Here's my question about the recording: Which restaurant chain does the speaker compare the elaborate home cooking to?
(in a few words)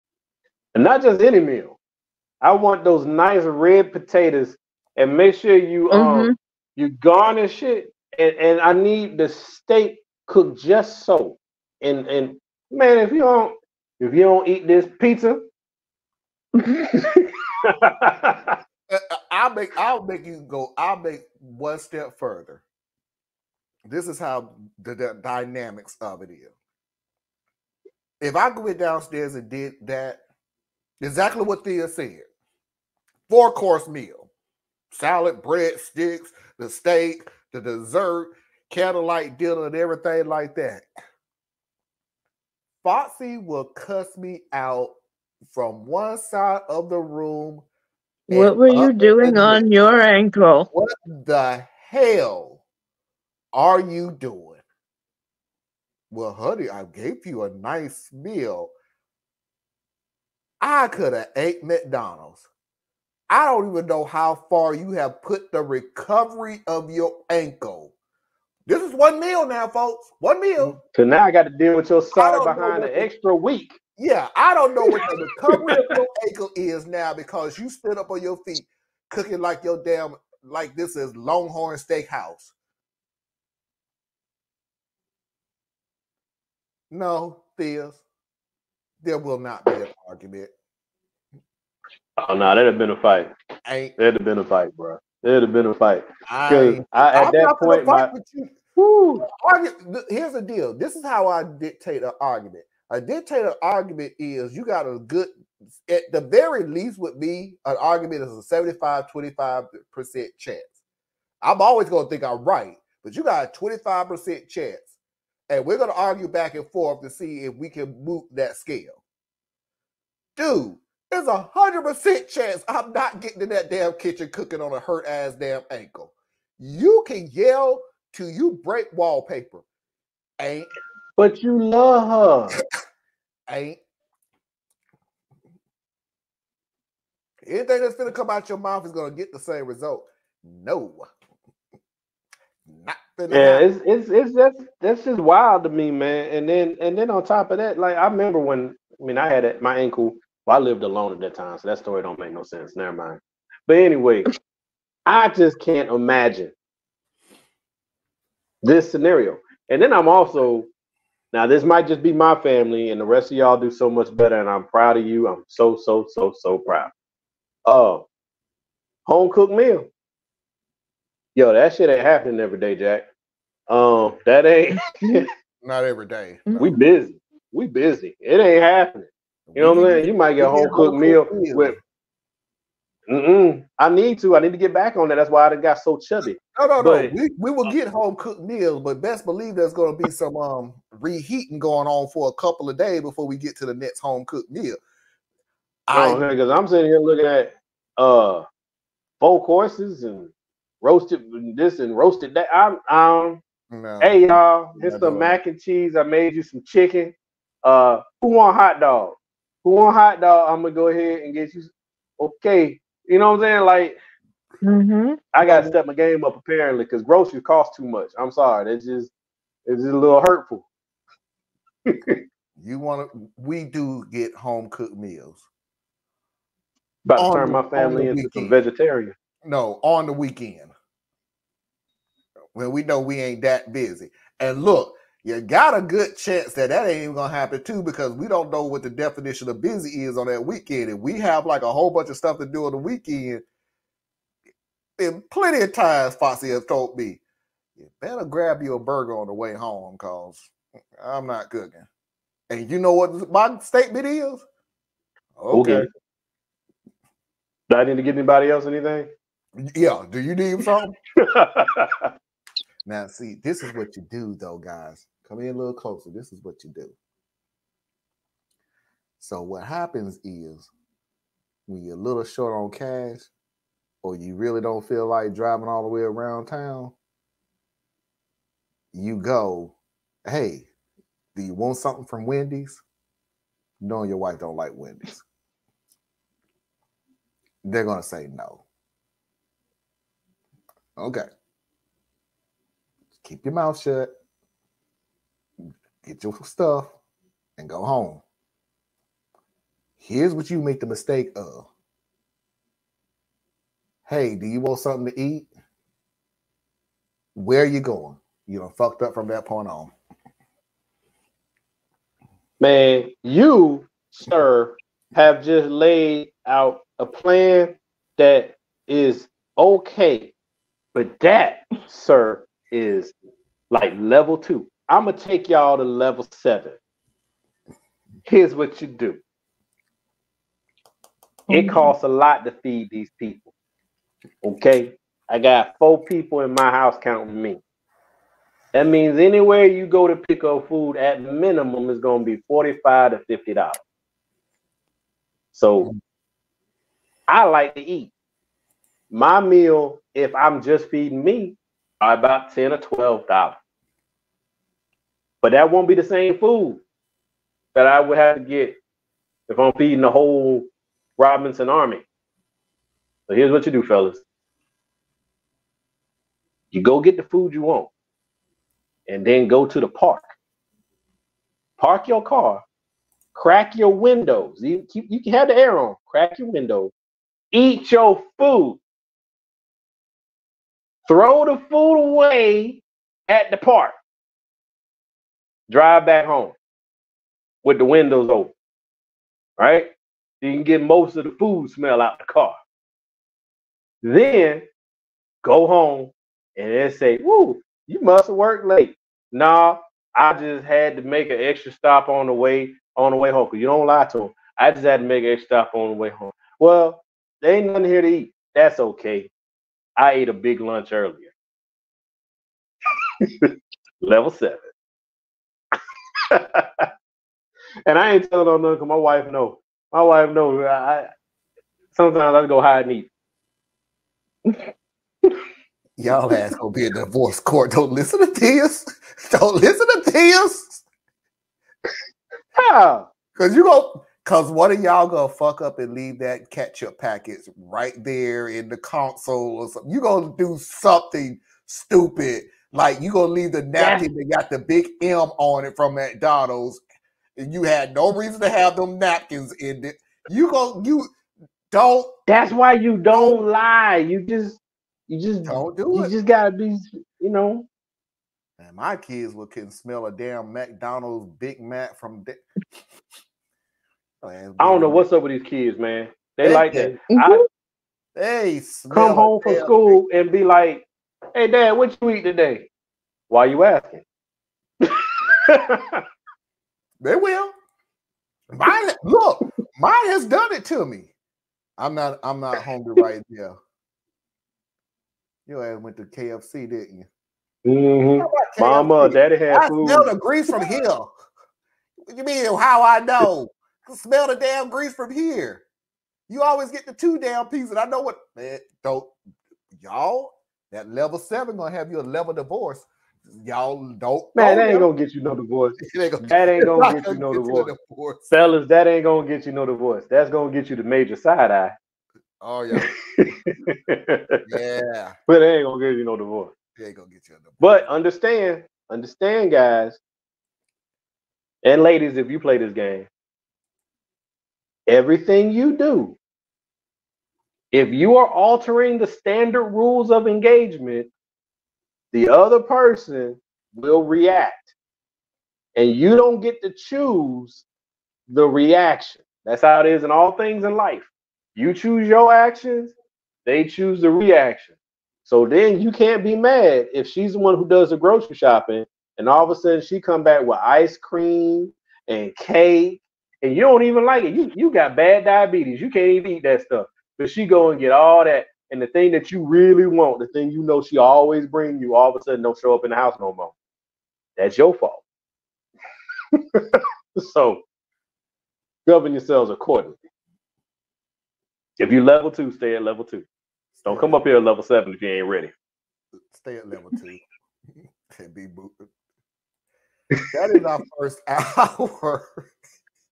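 Longhorn Steakhouse.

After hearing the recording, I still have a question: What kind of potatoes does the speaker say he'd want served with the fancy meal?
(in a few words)
red potatoes.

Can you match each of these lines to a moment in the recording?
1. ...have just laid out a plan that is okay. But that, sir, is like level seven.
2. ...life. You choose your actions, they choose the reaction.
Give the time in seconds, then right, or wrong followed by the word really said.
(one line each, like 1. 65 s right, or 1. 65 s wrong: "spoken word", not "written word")
1. 315 s wrong: "two", not "seven"
2. 540 s right.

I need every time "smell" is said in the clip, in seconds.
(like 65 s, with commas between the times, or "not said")
391 s, 459 s, 489 s, 493 s.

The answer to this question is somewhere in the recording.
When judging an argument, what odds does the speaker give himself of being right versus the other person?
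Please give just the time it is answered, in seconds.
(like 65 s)
108 s.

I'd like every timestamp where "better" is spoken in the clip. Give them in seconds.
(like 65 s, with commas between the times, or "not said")
164 s, 248 s.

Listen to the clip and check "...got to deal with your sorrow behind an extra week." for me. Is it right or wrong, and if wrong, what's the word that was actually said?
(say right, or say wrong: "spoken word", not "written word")
right.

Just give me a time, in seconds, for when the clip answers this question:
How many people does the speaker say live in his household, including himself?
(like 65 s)
335 s.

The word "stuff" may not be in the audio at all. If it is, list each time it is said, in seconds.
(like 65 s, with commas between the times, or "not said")
242 s, 296 s, 556 s.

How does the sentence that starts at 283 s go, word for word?
Knowing your wife don't like Wendy's.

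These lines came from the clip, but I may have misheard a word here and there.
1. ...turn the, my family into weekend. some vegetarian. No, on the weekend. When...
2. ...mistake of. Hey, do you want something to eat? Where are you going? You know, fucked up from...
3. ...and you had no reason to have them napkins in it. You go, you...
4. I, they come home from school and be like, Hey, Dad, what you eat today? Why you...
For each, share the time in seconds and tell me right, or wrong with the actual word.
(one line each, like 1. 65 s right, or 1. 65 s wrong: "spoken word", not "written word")
1. 227 s right
2. 300 s right
3. 447 s right
4. 467 s right.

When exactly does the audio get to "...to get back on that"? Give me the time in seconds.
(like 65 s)
184 s.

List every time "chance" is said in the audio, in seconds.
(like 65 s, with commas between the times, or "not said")
110 s, 114 s, 122 s, 236 s.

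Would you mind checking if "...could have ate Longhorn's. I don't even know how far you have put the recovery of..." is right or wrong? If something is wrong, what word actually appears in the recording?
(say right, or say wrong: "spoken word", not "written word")
wrong: "McDonald", not "Longhorn".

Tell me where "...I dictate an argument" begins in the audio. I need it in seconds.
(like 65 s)
101 s.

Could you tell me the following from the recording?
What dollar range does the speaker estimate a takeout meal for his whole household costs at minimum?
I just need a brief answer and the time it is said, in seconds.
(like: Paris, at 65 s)
$45 to $50, at 342 s.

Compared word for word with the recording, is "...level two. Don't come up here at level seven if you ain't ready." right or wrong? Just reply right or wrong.
right.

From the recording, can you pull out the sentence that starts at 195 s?
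I because I'm sitting here looking at uh four courses and roasted this and roasted that.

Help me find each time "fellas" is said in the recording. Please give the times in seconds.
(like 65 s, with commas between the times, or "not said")
363 s, 508 s.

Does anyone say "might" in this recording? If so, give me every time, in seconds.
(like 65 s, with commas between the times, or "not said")
161 s, 180 s.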